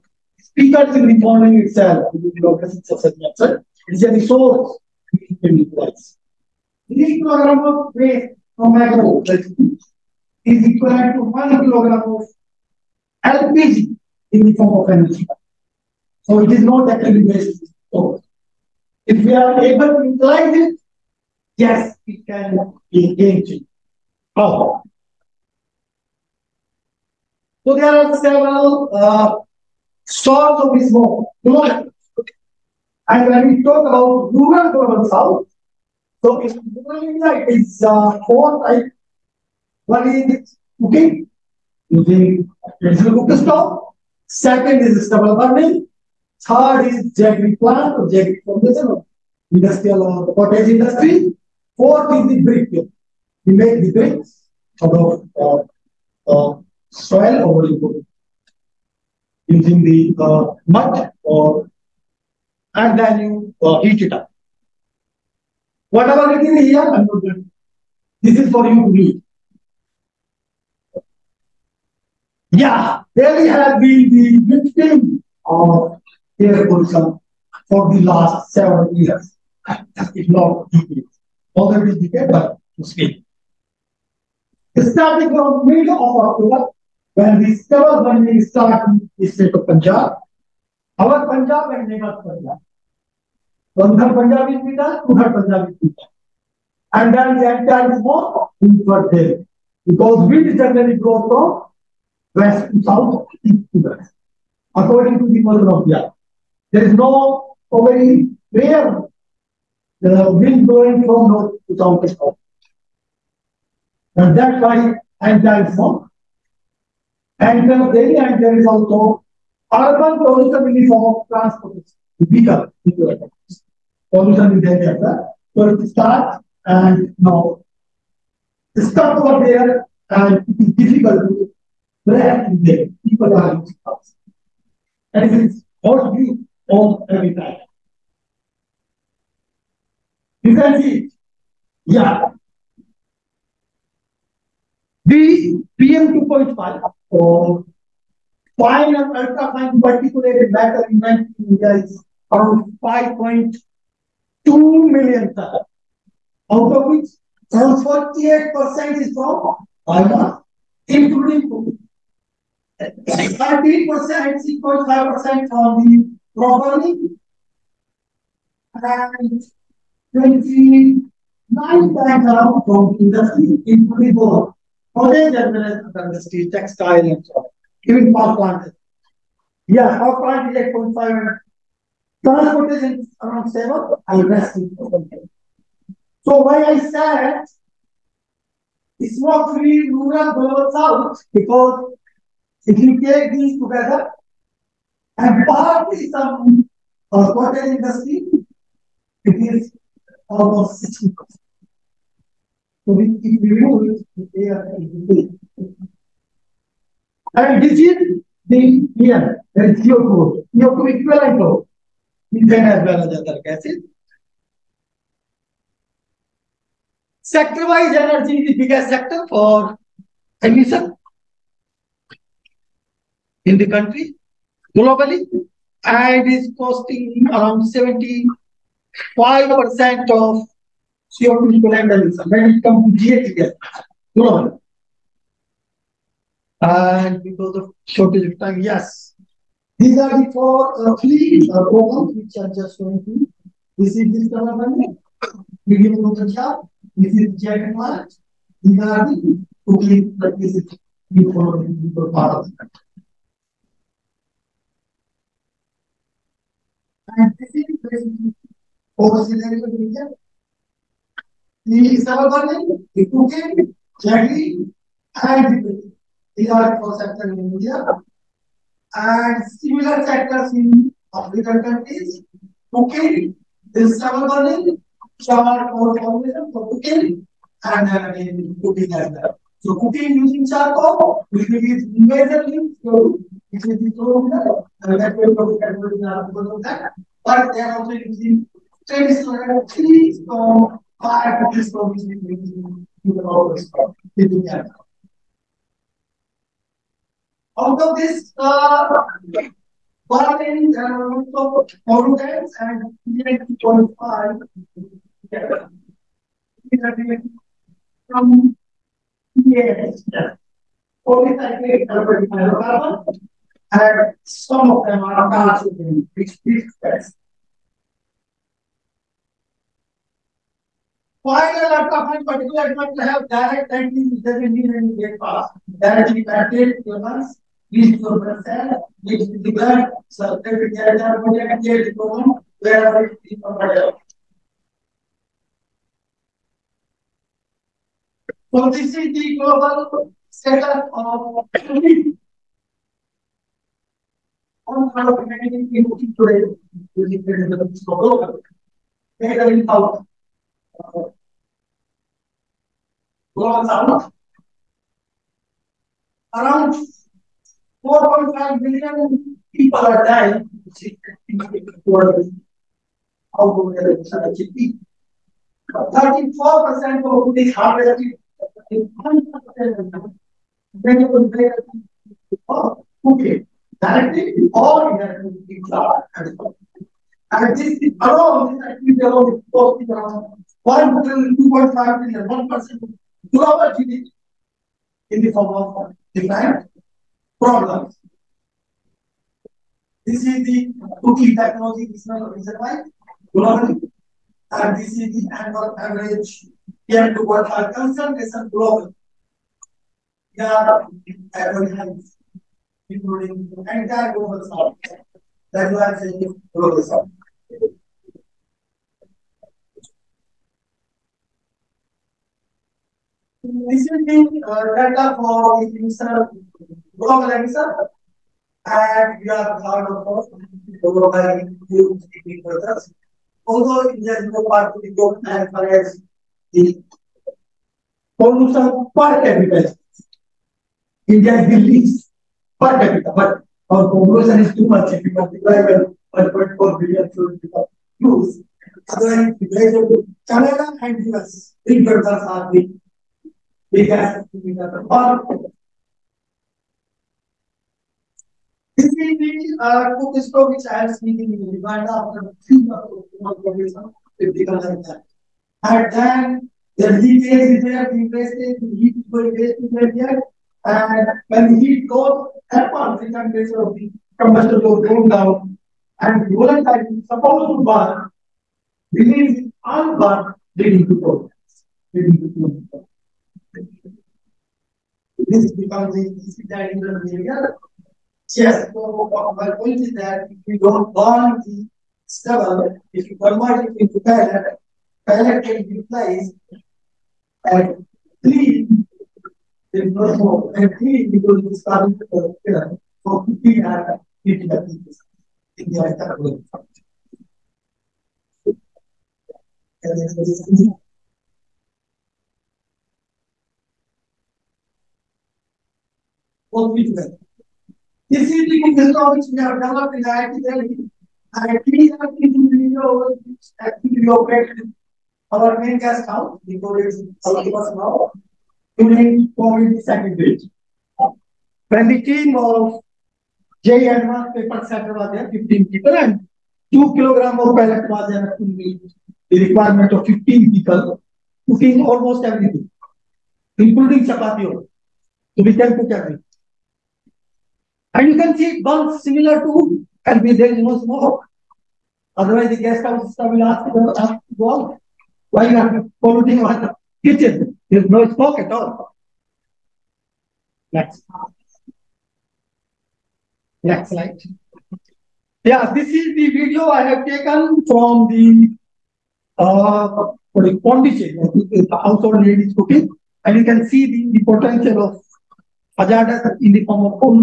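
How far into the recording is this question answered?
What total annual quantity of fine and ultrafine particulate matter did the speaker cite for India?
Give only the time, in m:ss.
2:32.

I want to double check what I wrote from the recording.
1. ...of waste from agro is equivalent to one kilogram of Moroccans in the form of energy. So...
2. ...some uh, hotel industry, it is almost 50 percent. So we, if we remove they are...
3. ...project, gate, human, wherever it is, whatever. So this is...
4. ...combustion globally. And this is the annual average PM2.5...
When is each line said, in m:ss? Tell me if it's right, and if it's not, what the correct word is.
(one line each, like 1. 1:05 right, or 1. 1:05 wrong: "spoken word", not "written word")
1. 0:07 wrong: "LPG", not "Moroccans"
2. 3:16 wrong: "60", not "50"
3. 5:31 right
4. 6:32 wrong: "reason", not "combustion".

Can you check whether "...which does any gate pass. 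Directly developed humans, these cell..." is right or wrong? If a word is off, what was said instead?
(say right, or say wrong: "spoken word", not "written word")
wrong: "connected", not "developed".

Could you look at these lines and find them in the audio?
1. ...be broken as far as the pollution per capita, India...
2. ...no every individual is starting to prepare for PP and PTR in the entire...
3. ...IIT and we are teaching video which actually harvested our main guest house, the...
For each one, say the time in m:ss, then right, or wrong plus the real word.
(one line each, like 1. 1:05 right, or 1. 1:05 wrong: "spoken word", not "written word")
1. 7:04 right
2. 8:09 right
3. 8:30 wrong: "operated", not "harvested".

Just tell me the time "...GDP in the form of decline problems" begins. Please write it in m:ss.
6:23.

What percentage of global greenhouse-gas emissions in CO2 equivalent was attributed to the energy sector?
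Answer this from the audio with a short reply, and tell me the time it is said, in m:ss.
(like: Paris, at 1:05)
75%, at 3:47.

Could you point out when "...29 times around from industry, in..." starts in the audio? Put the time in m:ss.
2:50.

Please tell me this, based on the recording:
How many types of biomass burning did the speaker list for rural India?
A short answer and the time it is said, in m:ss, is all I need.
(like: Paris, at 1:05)
4, at 0:38.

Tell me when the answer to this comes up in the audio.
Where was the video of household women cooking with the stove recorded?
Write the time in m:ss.
9:20.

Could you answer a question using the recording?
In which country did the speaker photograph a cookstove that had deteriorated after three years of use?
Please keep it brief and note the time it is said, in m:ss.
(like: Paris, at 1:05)
Uganda, at 7:31.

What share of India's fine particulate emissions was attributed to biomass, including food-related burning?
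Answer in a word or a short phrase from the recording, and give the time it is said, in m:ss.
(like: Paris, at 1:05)
48%, at 2:37.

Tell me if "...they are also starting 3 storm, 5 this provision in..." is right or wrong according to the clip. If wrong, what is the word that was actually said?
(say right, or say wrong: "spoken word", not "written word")
wrong: "using", not "starting".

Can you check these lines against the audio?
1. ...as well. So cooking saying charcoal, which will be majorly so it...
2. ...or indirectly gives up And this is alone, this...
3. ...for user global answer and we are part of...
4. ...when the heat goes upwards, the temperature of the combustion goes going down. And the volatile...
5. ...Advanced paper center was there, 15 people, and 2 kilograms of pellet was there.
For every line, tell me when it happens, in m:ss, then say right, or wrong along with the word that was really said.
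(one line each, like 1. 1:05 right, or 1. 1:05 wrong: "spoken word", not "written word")
1. 4:38 wrong: "using", not "saying"
2. 6:14 right
3. 6:55 right
4. 7:41 right
5. 8:43 right.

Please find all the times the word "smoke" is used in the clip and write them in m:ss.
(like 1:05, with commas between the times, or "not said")
1:38, 9:00, 9:08.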